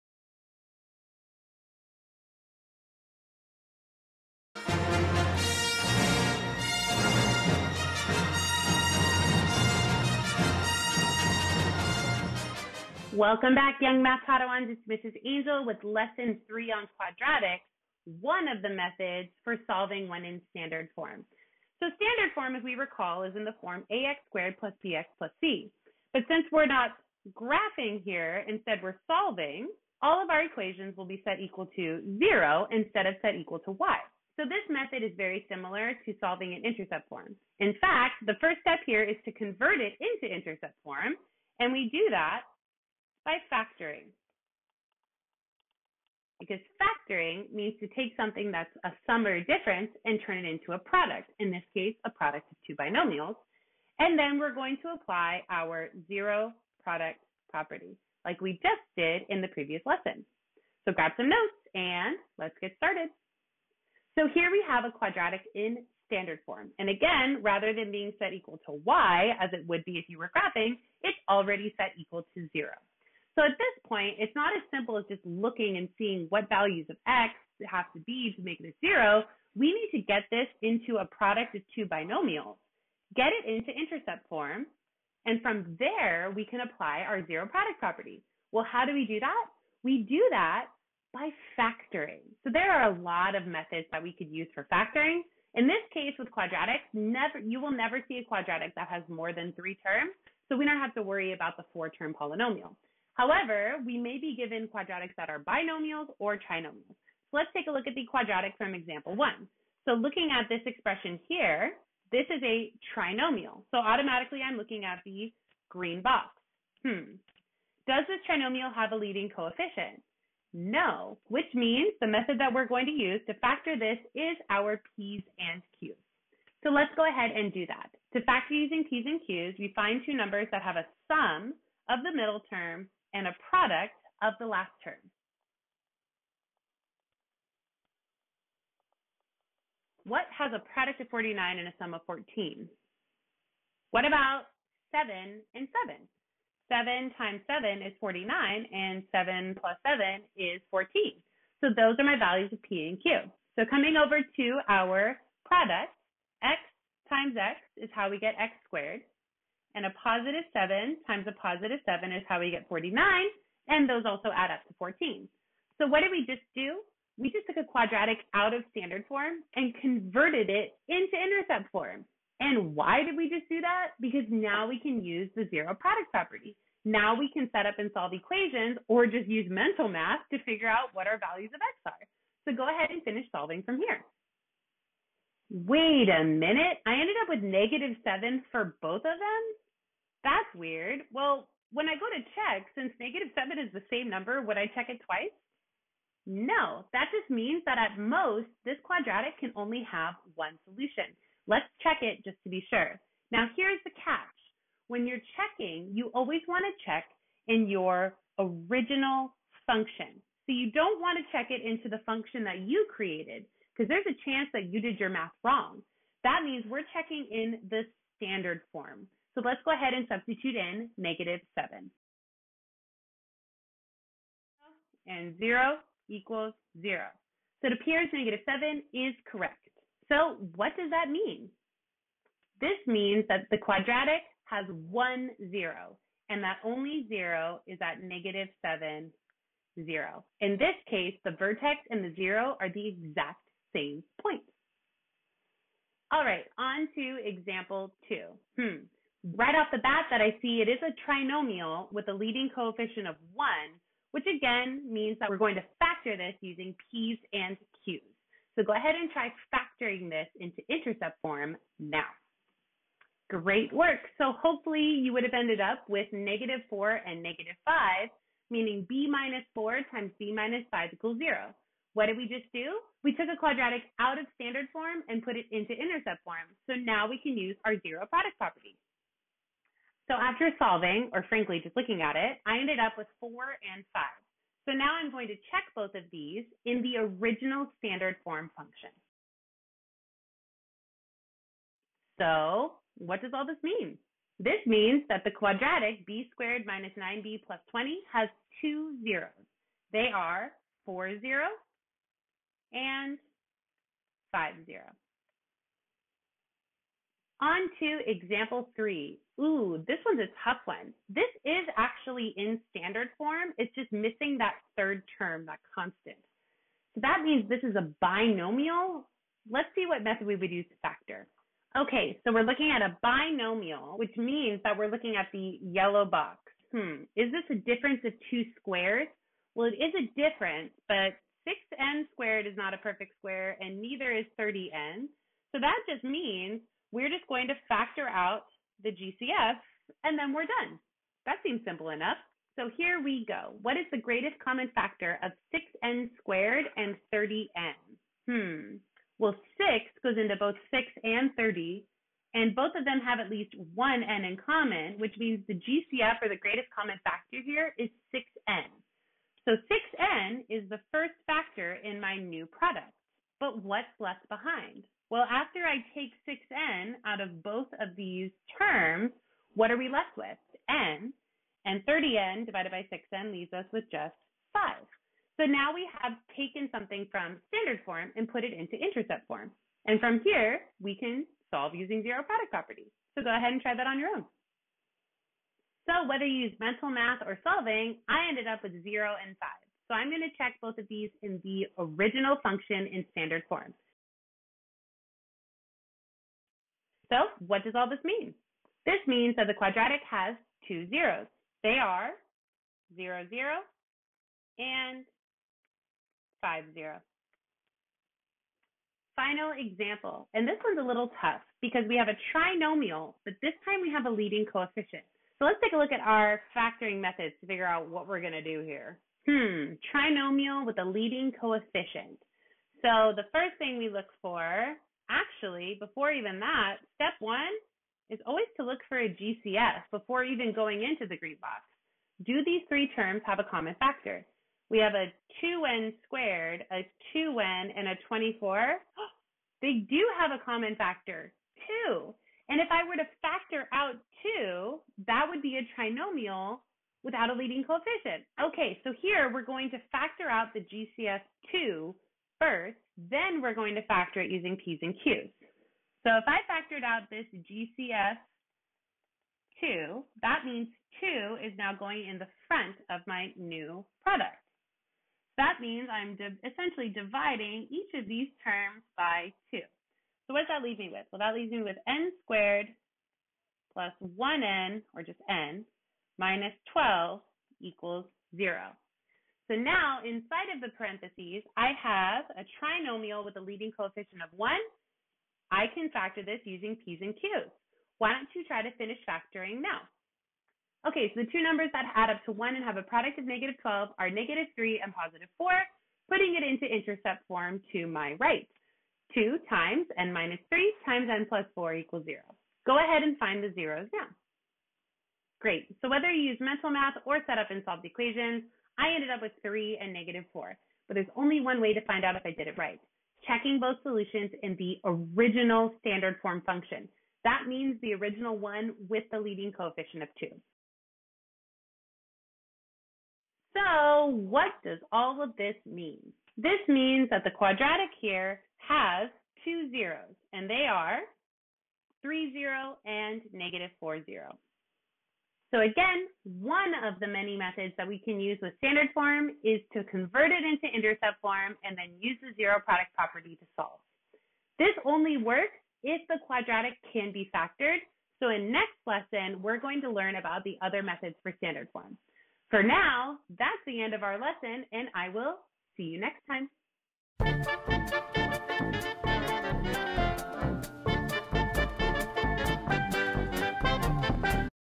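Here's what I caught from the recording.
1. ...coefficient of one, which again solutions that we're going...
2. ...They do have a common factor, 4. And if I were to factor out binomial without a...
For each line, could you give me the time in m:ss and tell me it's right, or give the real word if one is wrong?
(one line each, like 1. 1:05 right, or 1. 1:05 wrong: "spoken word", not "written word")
1. 4:12 wrong: "means", not "solutions"
2. 7:19 wrong: "2", not "4".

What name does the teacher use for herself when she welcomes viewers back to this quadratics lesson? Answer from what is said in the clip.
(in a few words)
Mrs. Angel.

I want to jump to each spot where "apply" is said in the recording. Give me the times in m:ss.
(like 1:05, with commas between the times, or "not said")
0:54, 1:26.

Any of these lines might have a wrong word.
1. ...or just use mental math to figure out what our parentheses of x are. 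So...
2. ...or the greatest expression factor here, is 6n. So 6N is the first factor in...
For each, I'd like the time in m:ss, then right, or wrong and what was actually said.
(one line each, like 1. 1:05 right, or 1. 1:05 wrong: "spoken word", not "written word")
1. 2:58 wrong: "values", not "parentheses"
2. 5:56 wrong: "common", not "expression".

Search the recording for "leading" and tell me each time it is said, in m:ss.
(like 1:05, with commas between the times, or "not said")
1:58, 4:12, 6:54, 7:00, 7:27, 8:03, 8:39.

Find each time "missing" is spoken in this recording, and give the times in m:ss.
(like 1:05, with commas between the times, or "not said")
5:13.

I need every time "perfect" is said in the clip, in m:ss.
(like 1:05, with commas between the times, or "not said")
5:32.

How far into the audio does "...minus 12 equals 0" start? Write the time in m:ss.
7:56.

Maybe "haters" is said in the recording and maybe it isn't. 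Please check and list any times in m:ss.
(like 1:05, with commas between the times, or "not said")
not said.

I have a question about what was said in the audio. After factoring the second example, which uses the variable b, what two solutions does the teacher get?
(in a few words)
4 and 5.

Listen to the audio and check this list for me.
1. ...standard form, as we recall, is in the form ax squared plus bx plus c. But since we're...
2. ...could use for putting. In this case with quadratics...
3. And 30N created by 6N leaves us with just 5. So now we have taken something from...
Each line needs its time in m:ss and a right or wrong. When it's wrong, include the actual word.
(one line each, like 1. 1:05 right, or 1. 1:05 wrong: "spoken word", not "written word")
1. 0:22 right
2. 1:34 wrong: "factoring", not "putting"
3. 6:11 wrong: "divided", not "created".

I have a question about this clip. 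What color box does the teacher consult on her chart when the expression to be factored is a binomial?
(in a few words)
yellow.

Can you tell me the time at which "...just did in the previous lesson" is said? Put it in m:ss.
0:58.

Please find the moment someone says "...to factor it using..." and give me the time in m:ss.
7:33.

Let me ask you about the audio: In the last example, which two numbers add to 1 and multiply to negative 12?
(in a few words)
-3 and 4.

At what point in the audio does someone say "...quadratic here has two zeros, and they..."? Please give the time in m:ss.
8:47.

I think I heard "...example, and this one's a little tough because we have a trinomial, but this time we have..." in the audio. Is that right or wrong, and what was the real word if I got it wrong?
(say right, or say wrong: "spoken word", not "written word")
right.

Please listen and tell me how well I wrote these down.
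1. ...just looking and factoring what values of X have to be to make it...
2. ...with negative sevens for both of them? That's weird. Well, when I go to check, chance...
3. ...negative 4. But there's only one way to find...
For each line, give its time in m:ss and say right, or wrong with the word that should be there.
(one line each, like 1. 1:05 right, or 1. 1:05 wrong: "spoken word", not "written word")
1. 1:15 wrong: "seeing", not "factoring"
2. 3:07 wrong: "since", not "chance"
3. 8:29 right.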